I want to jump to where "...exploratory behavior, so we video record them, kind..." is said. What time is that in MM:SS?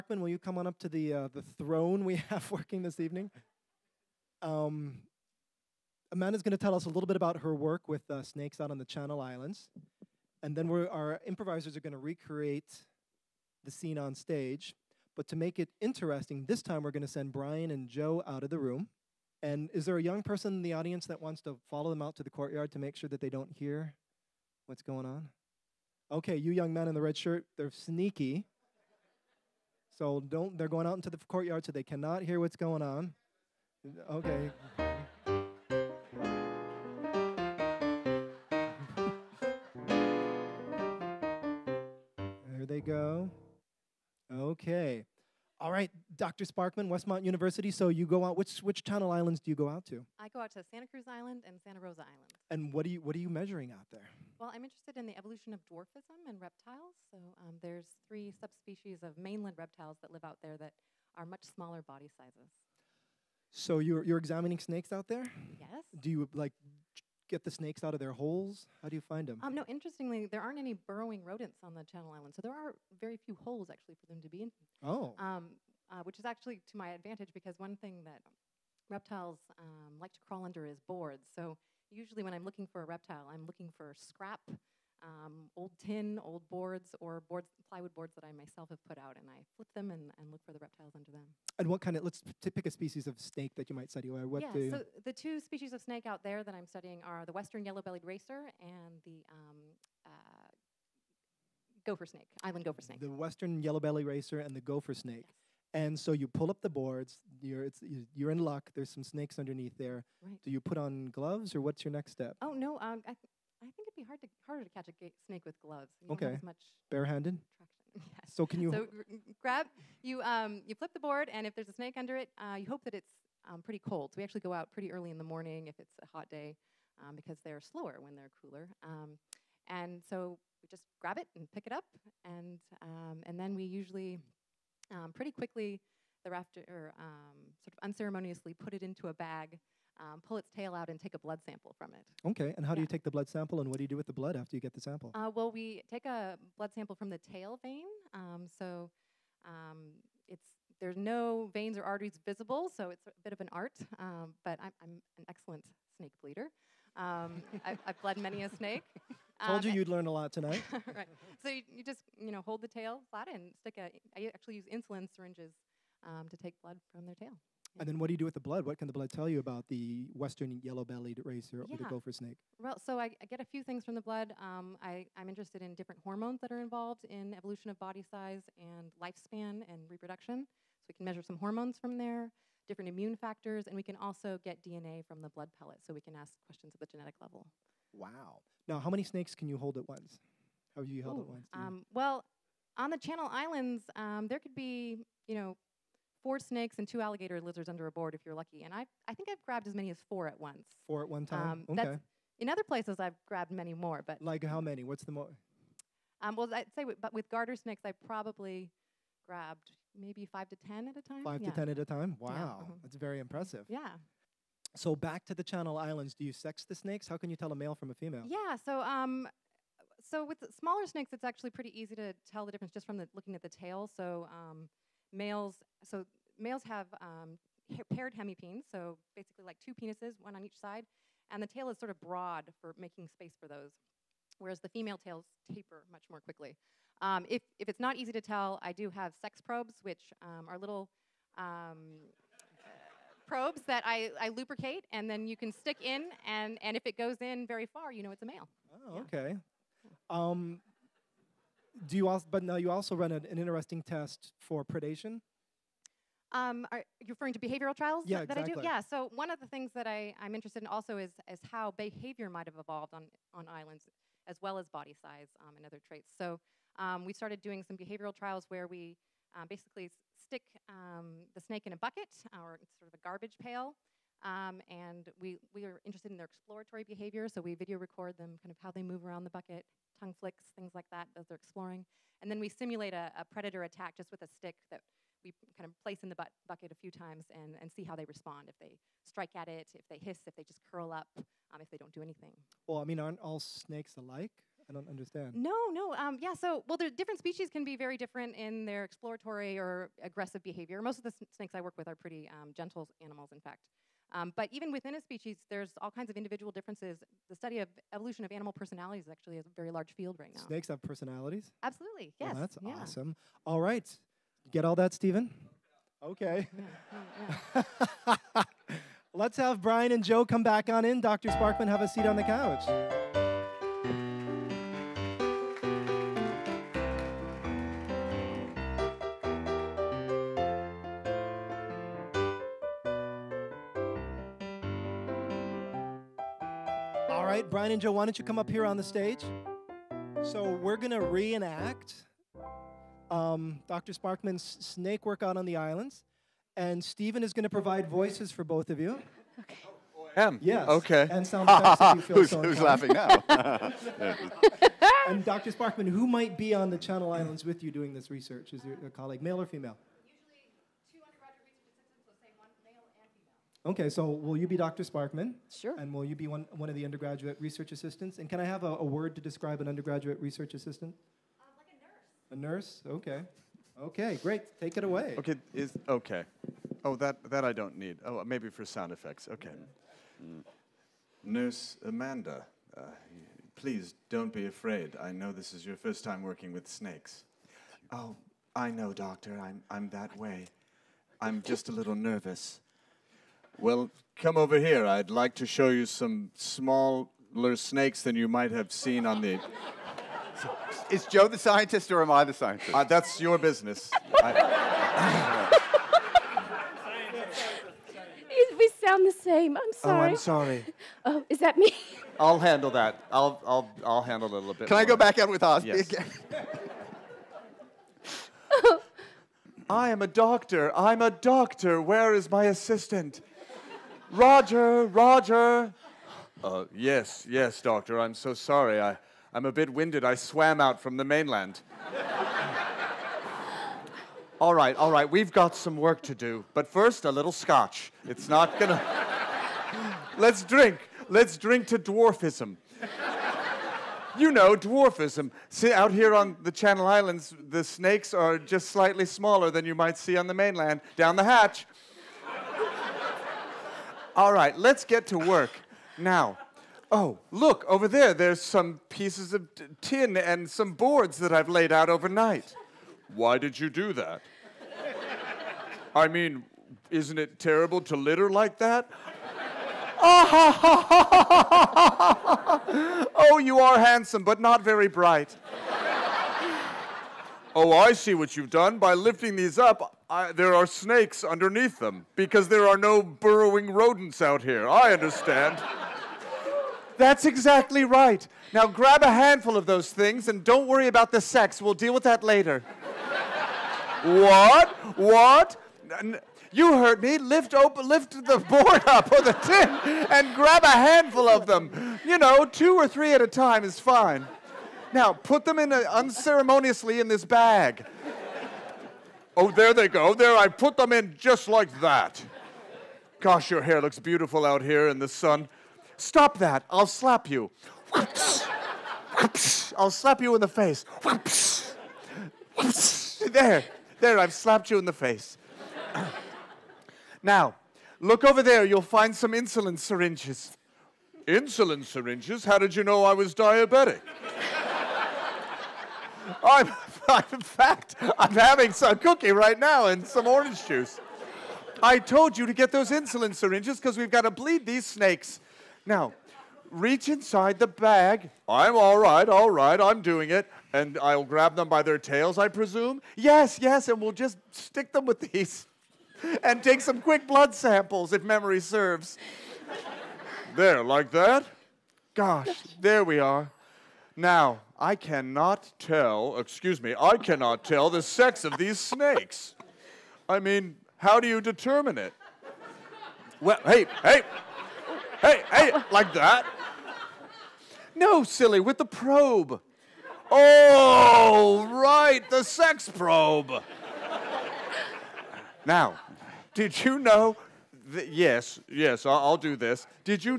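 04:36.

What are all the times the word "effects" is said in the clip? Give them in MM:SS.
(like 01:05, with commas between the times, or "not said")
05:51, 06:18.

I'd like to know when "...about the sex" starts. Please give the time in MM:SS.
08:10.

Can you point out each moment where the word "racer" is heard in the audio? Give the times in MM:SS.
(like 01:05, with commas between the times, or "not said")
01:38, 01:44, 02:51.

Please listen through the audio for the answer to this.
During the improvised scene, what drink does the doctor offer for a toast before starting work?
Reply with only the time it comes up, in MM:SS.
07:17.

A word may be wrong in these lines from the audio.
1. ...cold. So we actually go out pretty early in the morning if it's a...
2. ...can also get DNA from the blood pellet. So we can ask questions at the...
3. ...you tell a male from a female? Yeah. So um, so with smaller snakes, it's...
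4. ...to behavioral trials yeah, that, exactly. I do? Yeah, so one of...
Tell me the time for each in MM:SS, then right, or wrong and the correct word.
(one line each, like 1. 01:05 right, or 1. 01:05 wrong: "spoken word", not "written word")
1. 02:03 right
2. 03:03 right
3. 03:37 right
4. 04:17 right.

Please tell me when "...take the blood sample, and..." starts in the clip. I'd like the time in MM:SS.
02:22.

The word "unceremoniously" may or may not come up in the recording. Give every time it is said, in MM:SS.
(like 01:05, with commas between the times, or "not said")
02:17, 08:25.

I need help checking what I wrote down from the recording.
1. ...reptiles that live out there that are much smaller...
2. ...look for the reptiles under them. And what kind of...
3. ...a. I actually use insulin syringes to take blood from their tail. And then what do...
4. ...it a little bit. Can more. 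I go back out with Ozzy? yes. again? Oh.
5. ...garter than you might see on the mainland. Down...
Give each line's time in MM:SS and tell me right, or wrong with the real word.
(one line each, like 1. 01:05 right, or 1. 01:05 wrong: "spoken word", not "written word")
1. 00:59 right
2. 01:30 right
3. 02:43 right
4. 06:54 right
5. 07:29 wrong: "smaller", not "garter".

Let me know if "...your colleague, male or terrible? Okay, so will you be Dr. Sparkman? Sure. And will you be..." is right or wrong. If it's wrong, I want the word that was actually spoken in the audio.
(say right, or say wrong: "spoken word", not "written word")
wrong: "female", not "terrible".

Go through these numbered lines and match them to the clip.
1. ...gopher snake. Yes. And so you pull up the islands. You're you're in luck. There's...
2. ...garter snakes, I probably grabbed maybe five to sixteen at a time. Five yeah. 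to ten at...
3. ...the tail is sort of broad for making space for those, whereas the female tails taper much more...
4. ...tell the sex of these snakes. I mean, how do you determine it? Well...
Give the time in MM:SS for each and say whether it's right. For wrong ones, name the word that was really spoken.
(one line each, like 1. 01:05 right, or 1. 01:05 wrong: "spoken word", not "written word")
1. 01:44 wrong: "boards", not "islands"
2. 03:27 wrong: "ten", not "sixteen"
3. 03:51 right
4. 09:27 right.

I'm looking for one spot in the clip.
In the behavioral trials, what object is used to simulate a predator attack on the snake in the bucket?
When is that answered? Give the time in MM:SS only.
04:44.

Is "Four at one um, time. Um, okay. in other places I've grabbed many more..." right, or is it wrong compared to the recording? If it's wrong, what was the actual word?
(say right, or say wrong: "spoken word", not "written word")
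right.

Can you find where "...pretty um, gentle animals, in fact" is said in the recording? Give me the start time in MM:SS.
05:01.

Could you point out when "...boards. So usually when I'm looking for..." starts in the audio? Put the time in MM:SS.
01:20.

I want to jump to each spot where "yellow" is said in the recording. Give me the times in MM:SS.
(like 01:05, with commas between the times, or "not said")
01:37, 01:43, 02:50.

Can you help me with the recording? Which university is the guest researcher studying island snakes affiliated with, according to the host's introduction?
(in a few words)
Westmont University.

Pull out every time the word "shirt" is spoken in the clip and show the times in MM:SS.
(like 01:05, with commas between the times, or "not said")
00:27.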